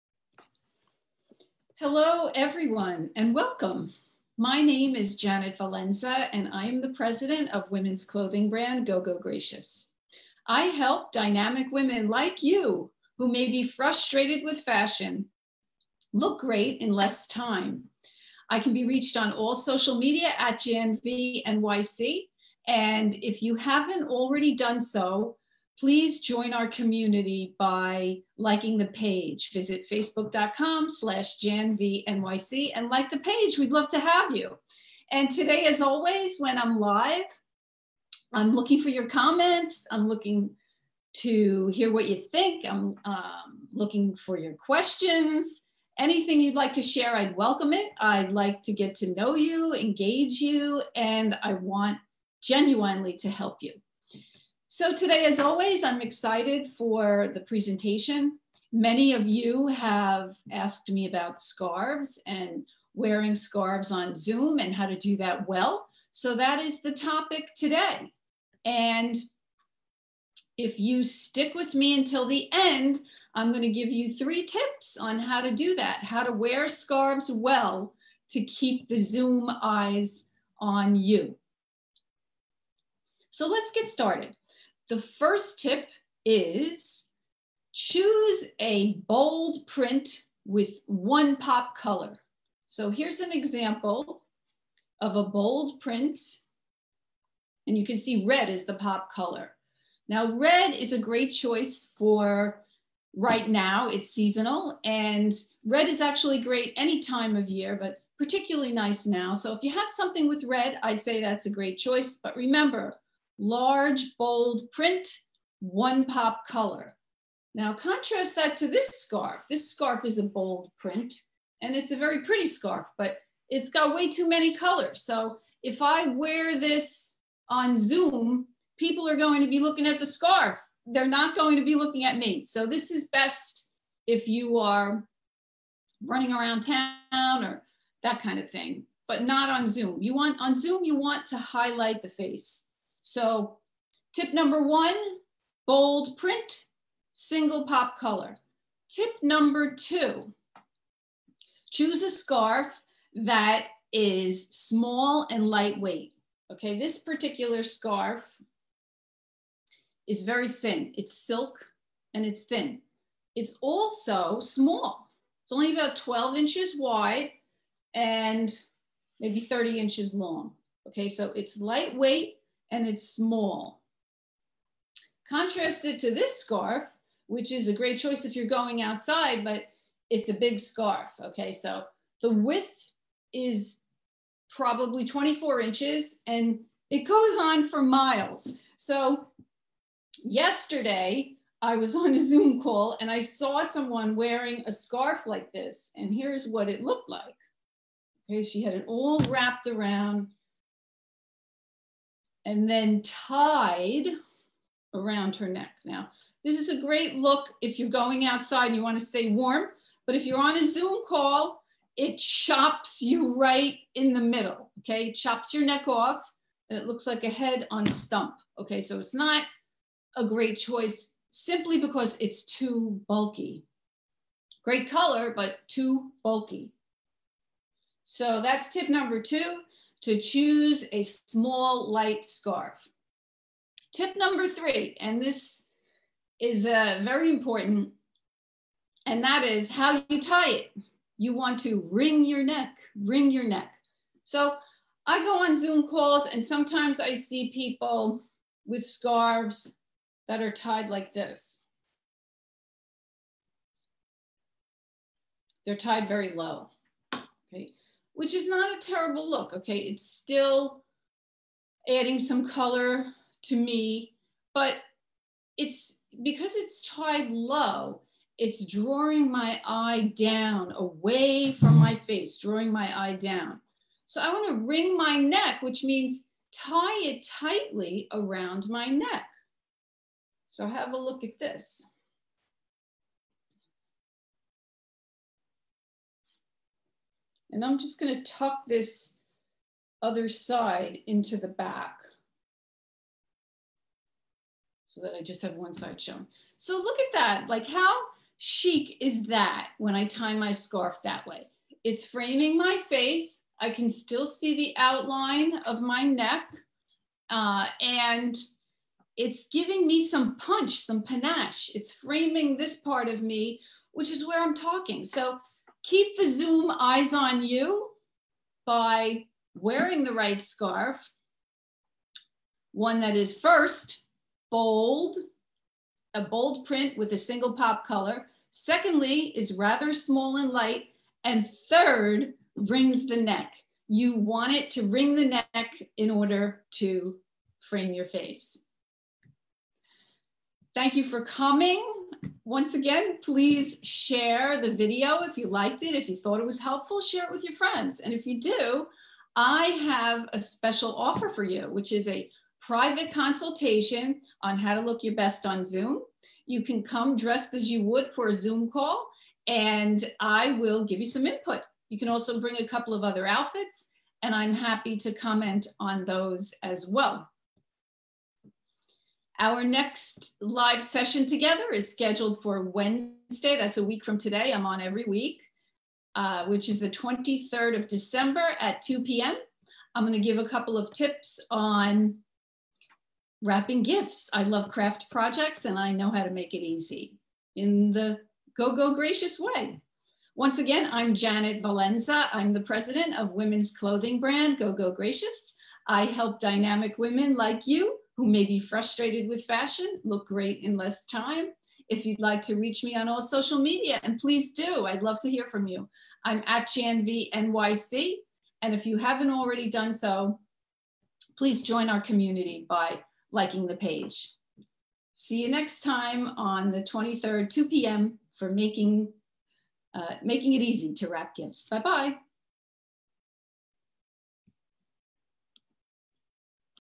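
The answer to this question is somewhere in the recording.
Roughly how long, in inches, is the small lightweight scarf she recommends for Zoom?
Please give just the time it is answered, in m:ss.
2:49.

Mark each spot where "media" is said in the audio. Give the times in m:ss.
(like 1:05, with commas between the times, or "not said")
0:19, 6:43.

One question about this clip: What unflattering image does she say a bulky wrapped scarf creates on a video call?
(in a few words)
Head on stump.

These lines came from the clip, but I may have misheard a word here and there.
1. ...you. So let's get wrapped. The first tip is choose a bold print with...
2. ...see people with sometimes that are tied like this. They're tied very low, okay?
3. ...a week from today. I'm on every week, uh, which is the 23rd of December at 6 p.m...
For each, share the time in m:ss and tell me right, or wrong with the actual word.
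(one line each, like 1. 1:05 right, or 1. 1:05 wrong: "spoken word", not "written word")
1. 1:20 wrong: "started", not "wrapped"
2. 4:07 wrong: "scarves", not "sometimes"
3. 6:13 wrong: "2", not "6".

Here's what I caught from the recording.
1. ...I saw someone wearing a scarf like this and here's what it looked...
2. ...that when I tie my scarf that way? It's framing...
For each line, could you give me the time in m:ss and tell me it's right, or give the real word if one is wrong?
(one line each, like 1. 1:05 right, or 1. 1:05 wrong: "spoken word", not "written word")
1. 3:13 right
2. 4:59 right.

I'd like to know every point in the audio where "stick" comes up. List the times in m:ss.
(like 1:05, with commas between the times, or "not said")
1:11.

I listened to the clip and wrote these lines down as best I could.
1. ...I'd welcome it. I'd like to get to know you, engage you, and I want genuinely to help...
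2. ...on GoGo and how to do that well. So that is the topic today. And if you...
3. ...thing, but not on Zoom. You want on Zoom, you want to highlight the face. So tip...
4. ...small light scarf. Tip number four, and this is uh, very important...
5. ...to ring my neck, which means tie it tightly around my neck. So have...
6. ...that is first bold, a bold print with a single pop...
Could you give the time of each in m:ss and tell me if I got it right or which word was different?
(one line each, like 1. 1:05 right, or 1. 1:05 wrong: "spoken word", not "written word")
1. 0:47 right
2. 1:03 wrong: "Zoom", not "GoGo"
3. 2:18 right
4. 3:51 wrong: "three", not "four"
5. 4:34 right
6. 5:23 right.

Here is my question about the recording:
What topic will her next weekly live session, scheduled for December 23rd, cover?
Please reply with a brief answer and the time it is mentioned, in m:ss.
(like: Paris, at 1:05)
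Wrapping gifts, at 6:23.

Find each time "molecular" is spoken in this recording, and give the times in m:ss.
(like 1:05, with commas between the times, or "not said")
not said.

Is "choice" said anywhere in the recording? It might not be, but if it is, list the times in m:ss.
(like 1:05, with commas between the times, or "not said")
1:41, 1:51, 2:57, 3:40.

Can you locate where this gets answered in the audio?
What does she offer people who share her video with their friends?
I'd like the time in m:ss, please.
5:52.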